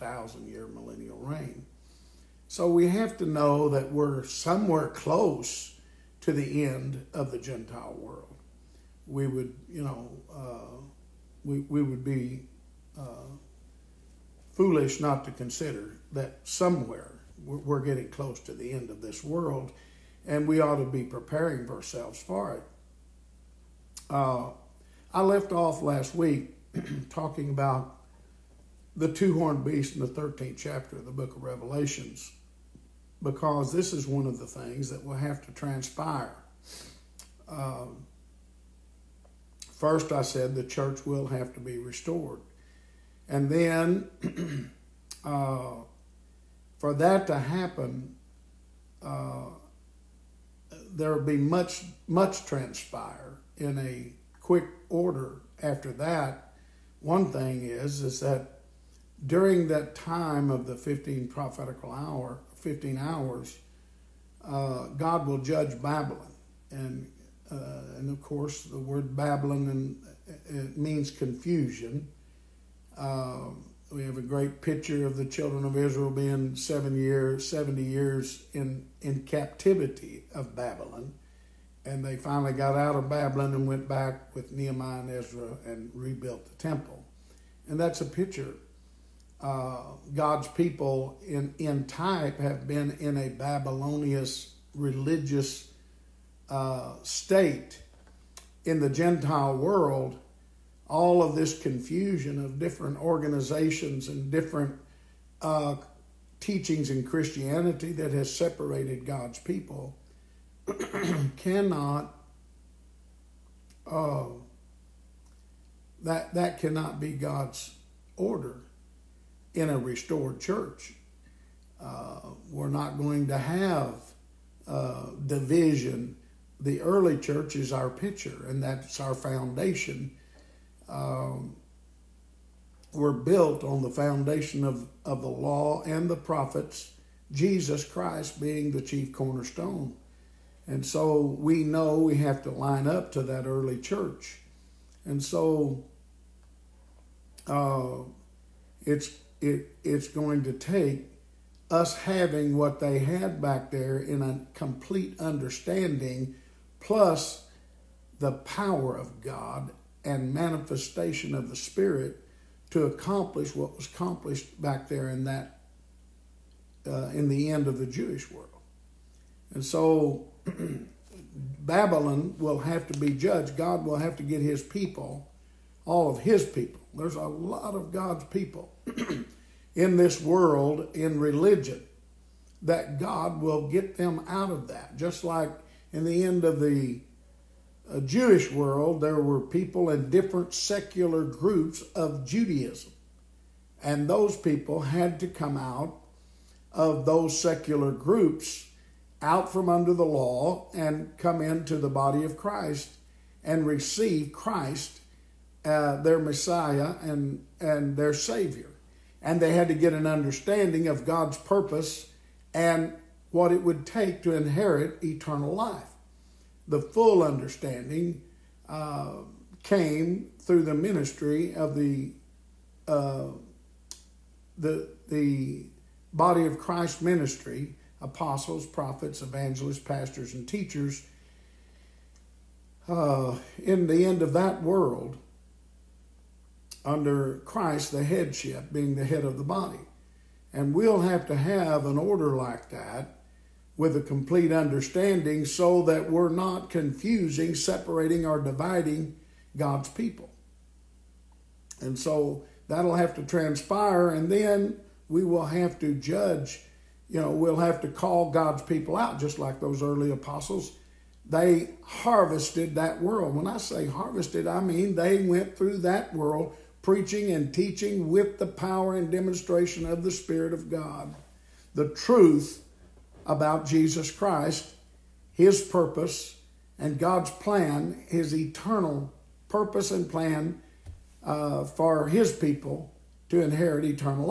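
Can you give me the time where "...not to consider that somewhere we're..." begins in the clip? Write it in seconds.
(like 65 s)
14 s.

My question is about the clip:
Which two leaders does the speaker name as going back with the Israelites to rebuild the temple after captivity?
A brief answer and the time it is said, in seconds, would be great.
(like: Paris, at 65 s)
Nehemiah and Ezra, at 84 s.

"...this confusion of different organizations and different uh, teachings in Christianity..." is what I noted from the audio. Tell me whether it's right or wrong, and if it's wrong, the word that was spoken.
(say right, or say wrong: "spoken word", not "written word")
right.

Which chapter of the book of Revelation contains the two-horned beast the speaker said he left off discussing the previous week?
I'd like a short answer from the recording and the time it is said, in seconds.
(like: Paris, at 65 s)
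13th, at 30 s.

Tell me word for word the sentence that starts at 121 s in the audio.
Uh, we're not going to have uh, division.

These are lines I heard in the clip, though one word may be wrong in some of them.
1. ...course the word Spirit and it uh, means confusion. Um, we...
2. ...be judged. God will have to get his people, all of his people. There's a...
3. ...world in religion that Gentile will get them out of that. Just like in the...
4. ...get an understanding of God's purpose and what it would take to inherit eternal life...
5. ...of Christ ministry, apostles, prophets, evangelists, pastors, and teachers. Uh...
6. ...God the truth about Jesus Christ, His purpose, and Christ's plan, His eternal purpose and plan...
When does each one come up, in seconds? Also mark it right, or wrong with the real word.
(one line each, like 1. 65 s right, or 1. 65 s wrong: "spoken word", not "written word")
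1. 68 s wrong: "Babylon", not "Spirit"
2. 172 s right
3. 180 s wrong: "God", not "Gentile"
4. 209 s right
5. 226 s right
6. 270 s wrong: "God", not "Christ".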